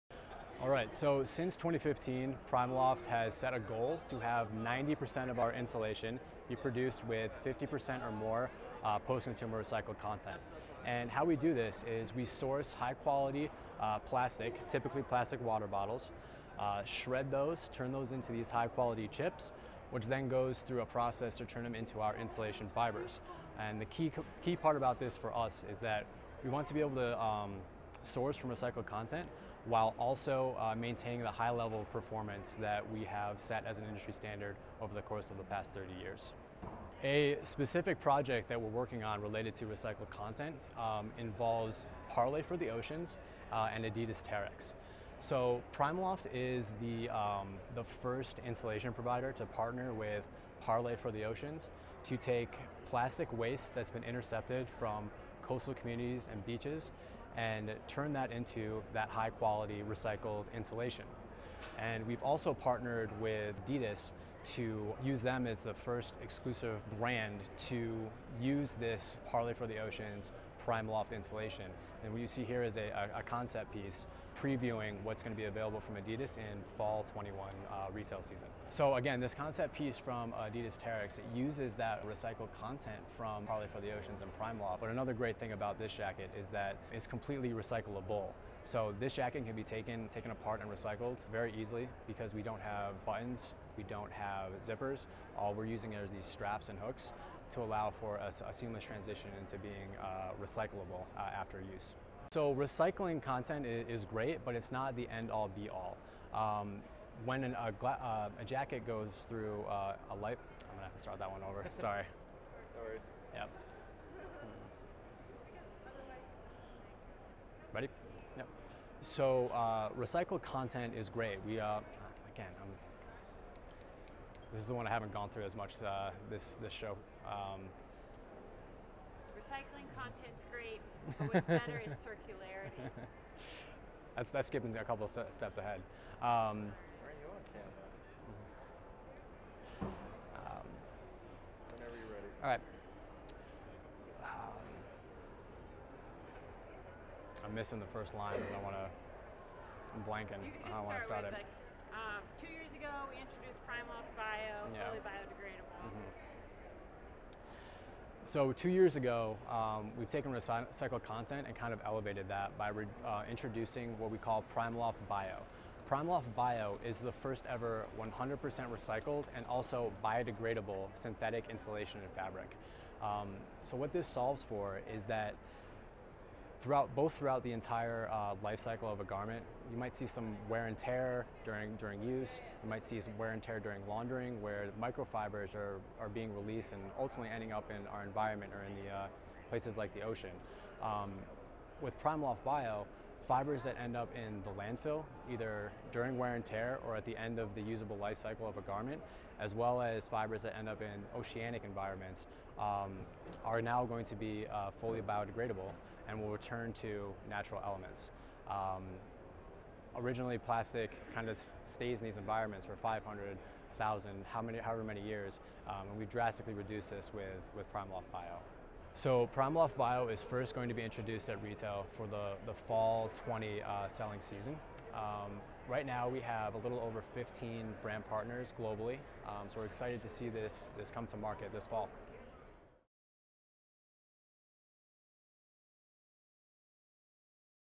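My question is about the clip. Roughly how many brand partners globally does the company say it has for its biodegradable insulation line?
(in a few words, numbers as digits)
Over 15.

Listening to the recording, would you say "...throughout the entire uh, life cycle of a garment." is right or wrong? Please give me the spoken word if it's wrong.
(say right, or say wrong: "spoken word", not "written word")
right.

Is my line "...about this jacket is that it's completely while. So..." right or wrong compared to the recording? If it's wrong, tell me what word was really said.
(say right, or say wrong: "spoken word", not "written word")
wrong: "recyclable", not "while".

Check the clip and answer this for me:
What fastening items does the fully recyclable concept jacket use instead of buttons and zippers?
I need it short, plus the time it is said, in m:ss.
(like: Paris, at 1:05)
Straps and hooks, at 1:36.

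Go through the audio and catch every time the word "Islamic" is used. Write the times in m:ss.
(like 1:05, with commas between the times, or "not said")
not said.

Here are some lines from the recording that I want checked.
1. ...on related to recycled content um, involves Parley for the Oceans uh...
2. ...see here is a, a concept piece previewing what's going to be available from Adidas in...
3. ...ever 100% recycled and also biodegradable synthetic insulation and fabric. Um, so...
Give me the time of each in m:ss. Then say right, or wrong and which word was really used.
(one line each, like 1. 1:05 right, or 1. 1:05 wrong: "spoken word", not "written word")
1. 0:39 right
2. 1:12 right
3. 2:47 right.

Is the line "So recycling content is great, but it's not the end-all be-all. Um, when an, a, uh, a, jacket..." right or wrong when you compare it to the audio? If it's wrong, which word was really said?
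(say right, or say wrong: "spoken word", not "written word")
right.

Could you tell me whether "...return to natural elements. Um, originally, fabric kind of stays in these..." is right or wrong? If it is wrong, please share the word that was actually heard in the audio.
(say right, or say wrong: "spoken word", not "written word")
wrong: "plastic", not "fabric".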